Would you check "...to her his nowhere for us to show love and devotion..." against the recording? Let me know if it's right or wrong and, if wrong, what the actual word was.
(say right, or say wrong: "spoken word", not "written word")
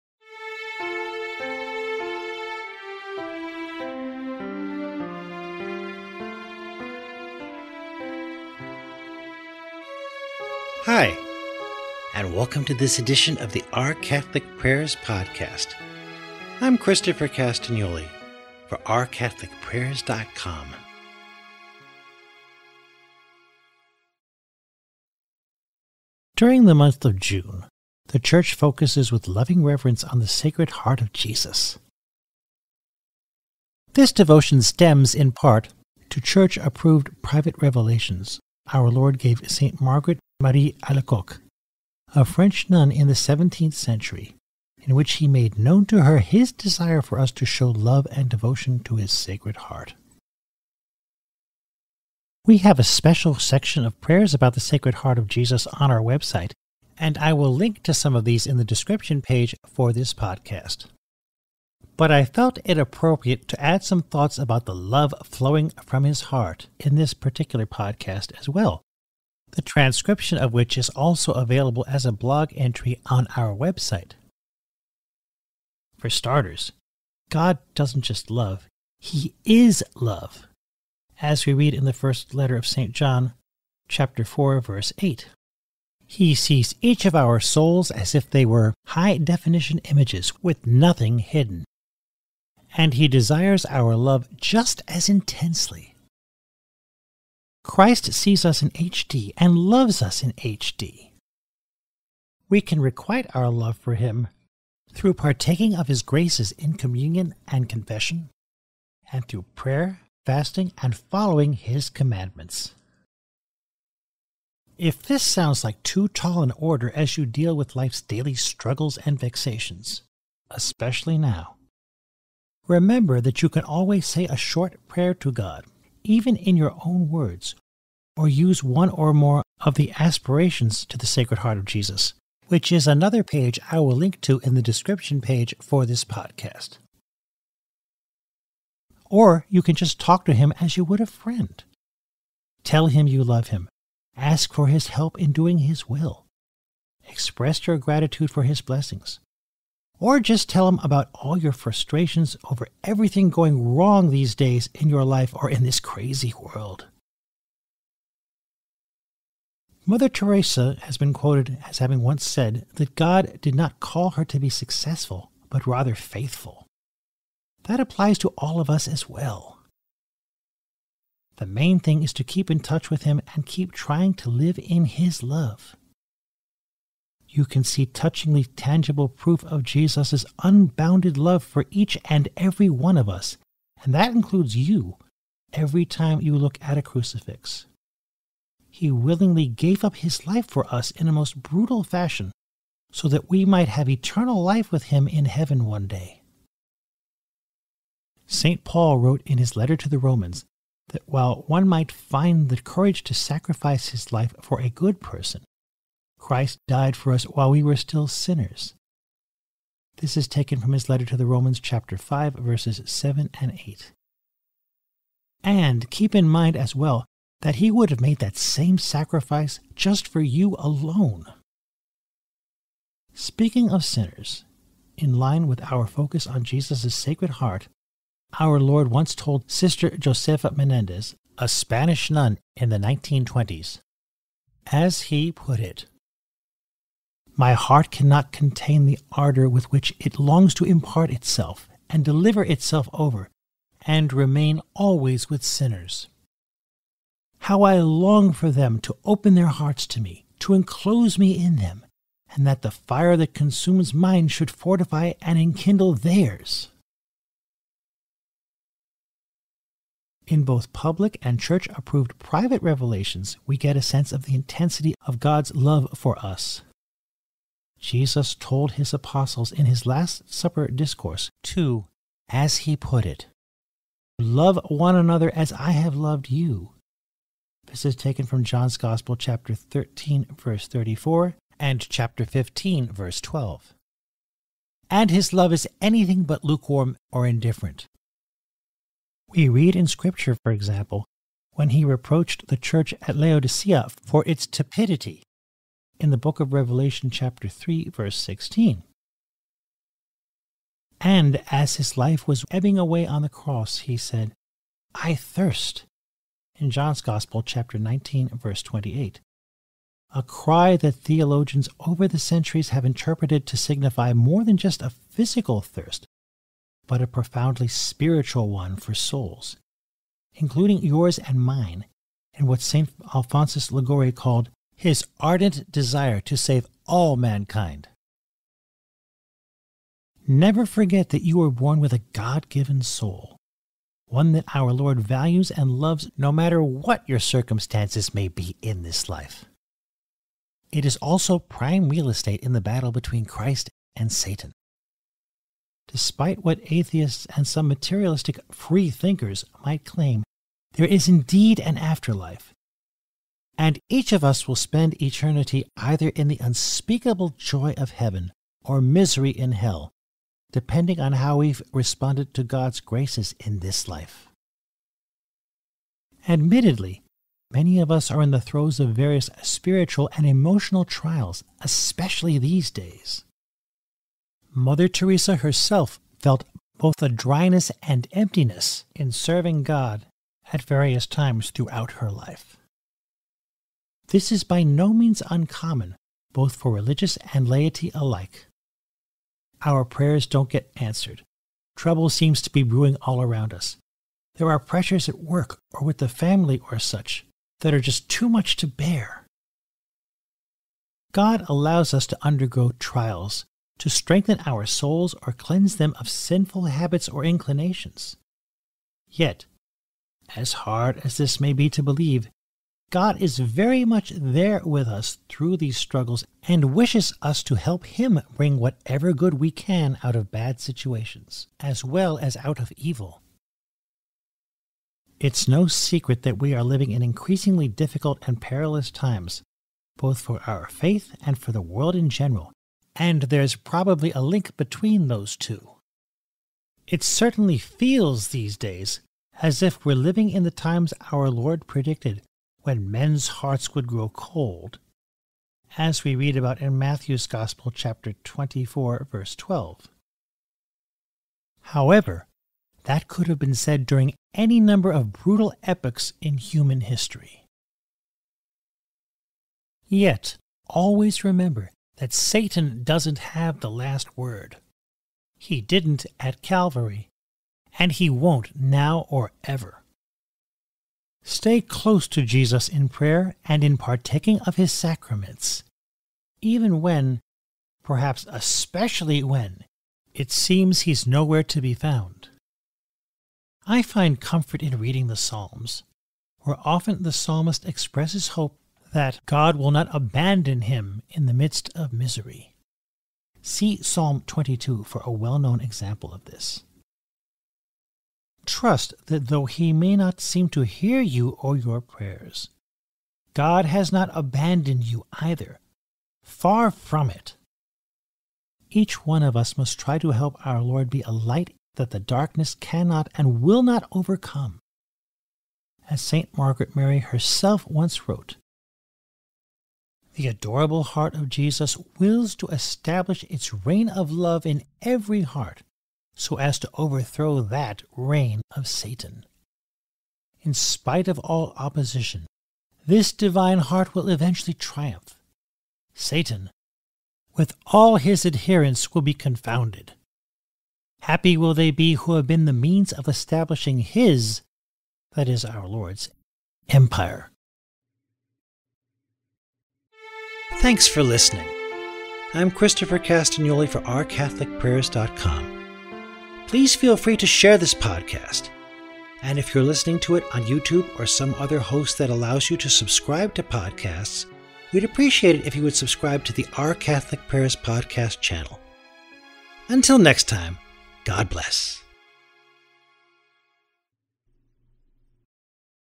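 wrong: "desire", not "nowhere".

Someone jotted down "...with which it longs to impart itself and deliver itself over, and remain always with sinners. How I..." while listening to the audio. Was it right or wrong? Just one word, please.
right.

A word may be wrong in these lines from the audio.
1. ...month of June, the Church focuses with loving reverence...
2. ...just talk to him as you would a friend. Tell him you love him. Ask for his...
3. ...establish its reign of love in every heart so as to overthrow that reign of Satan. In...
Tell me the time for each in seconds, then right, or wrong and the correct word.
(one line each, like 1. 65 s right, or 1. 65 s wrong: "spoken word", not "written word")
1. 26 s right
2. 139 s right
3. 522 s right.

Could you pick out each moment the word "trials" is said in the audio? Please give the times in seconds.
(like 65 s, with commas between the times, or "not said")
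370 s, 402 s.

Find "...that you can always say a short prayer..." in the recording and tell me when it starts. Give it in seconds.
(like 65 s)
123 s.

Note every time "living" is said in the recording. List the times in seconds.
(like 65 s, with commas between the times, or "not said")
426 s, 439 s.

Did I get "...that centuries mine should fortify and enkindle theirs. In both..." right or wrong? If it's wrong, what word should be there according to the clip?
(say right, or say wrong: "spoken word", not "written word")
wrong: "consumes", not "centuries".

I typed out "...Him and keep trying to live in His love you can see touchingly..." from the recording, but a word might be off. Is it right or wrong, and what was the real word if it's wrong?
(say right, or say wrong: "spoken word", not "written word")
right.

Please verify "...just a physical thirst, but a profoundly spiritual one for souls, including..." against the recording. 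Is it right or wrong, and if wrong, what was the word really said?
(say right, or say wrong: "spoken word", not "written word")
right.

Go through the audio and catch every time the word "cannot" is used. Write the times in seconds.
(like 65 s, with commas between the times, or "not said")
237 s, 512 s.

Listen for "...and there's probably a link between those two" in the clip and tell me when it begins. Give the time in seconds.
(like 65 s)
432 s.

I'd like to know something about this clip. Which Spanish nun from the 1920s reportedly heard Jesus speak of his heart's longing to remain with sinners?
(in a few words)
Sister Josefa Menendez.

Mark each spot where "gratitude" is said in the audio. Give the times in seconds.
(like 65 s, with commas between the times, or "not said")
147 s.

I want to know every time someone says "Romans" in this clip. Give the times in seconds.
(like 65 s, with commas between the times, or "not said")
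199 s, 211 s.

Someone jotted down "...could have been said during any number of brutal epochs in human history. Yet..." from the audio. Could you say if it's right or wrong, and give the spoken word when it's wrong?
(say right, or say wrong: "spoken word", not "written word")
right.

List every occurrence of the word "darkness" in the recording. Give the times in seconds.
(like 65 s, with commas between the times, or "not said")
511 s.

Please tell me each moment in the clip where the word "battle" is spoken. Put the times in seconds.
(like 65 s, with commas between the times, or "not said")
342 s.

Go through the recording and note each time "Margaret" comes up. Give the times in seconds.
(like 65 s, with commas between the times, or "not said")
39 s, 516 s.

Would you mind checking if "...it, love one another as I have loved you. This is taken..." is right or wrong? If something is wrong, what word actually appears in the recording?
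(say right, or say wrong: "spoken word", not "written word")
right.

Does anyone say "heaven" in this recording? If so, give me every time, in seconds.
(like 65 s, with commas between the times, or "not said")
195 s, 357 s.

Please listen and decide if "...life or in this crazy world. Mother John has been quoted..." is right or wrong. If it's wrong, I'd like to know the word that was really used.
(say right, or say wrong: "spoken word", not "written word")
wrong: "Teresa", not "John".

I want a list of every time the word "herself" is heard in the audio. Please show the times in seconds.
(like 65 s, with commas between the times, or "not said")
375 s, 516 s.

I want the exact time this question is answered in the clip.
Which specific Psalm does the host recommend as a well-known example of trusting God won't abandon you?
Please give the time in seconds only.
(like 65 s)
493 s.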